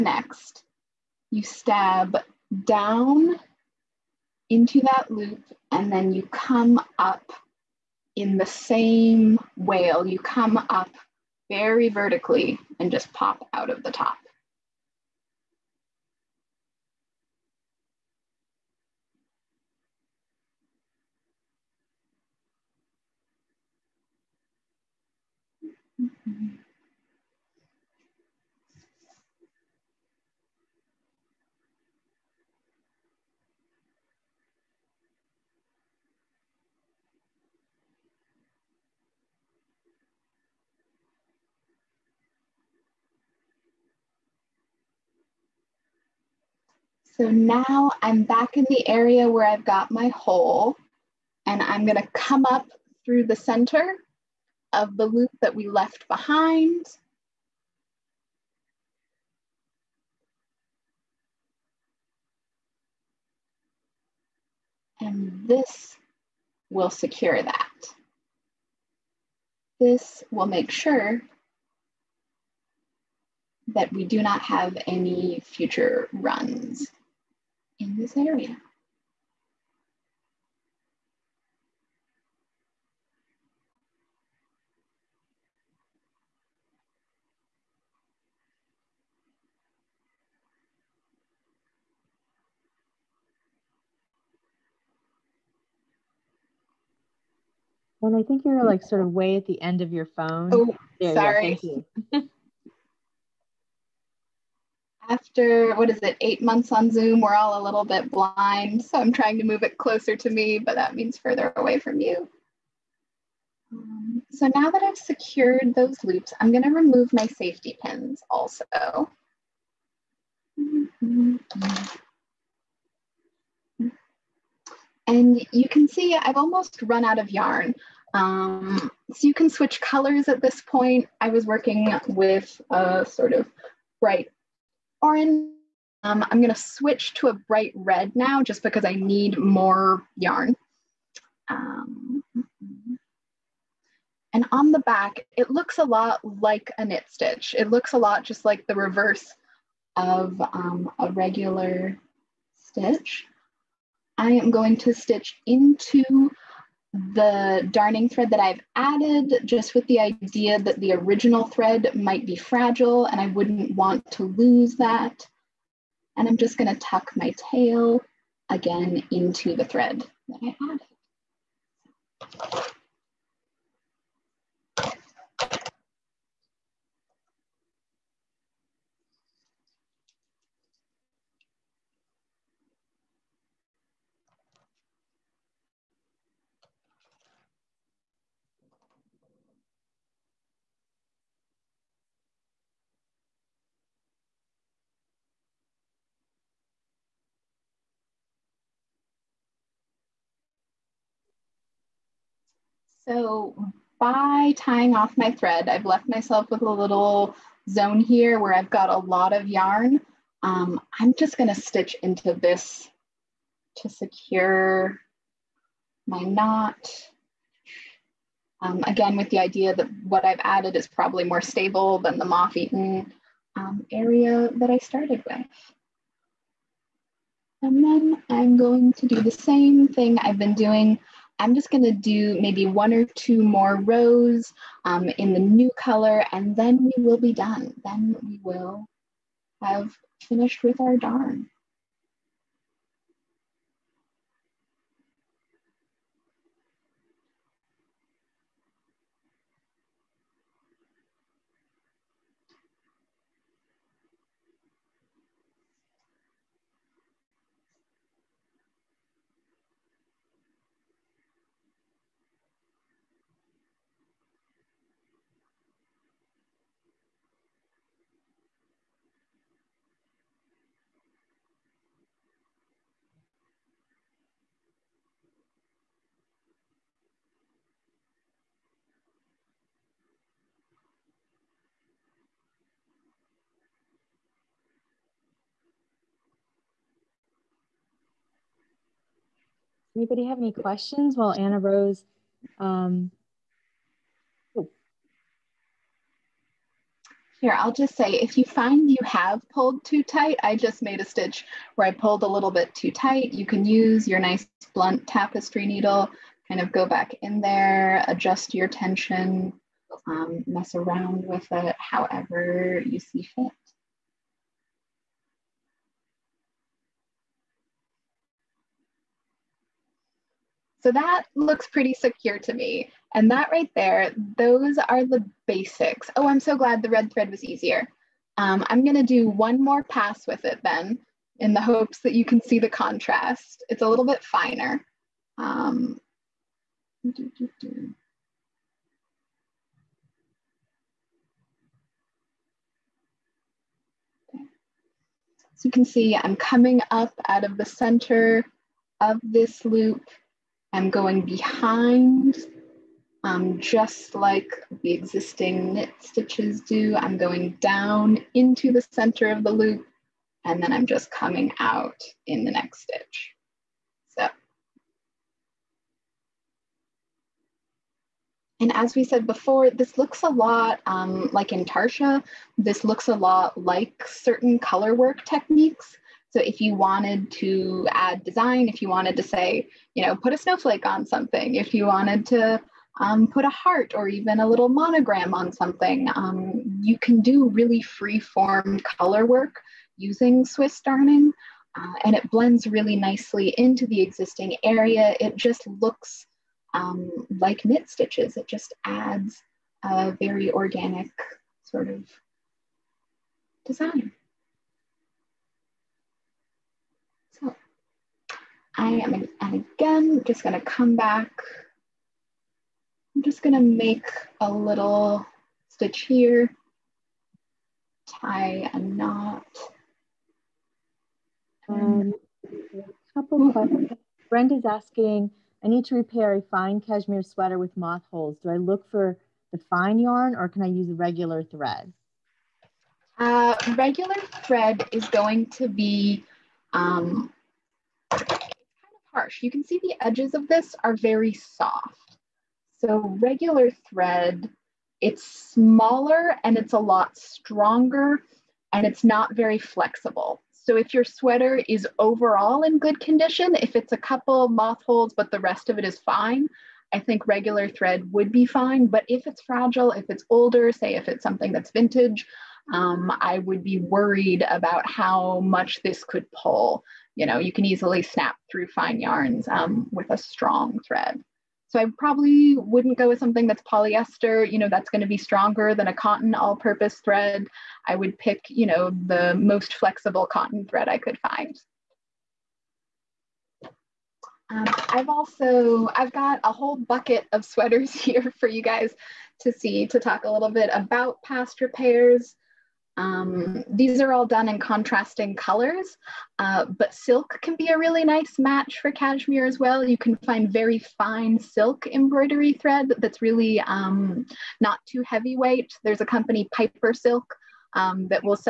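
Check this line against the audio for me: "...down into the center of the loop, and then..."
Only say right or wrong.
right.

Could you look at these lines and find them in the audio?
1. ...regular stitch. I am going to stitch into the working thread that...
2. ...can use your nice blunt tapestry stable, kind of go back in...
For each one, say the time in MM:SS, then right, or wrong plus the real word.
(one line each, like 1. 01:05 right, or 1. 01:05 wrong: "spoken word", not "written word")
1. 02:31 wrong: "darning", not "working"
2. 05:03 wrong: "needle", not "stable".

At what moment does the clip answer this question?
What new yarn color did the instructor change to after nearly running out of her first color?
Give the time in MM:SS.
02:17.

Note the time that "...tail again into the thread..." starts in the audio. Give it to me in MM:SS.
02:47.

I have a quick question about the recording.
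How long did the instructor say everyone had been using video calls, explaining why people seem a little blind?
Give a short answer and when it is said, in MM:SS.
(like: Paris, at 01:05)
eight months, at 01:46.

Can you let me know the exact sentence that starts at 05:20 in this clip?
So that looks pretty secure to me.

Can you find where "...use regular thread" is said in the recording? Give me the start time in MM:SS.
07:10.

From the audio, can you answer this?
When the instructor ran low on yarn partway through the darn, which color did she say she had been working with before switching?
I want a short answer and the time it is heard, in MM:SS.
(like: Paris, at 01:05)
bright orange, at 02:14.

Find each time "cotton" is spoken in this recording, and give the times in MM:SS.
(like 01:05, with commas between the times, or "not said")
07:55, 08:00.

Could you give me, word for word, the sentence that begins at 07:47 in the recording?
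You know, you can easily snap through fine yarns um, with a strong thread.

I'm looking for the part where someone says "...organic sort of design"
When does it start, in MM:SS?
06:40.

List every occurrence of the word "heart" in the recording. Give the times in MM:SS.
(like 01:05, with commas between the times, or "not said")
06:23.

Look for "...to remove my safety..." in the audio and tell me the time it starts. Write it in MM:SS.
01:56.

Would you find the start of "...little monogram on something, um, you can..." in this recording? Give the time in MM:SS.
06:24.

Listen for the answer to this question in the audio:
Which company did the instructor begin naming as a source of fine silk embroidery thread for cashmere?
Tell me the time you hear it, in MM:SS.
08:26.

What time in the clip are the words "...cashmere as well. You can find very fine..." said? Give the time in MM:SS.
08:18.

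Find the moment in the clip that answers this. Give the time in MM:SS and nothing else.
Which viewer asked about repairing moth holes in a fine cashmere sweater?
07:04.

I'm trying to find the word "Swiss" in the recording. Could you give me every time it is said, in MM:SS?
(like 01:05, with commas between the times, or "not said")
06:30.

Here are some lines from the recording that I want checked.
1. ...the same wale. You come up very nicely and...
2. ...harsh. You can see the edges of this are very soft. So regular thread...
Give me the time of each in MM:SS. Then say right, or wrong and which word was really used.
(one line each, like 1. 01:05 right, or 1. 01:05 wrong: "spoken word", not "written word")
1. 00:08 wrong: "vertically", not "nicely"
2. 07:19 right.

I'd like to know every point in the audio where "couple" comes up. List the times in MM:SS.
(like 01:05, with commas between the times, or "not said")
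07:03, 07:33.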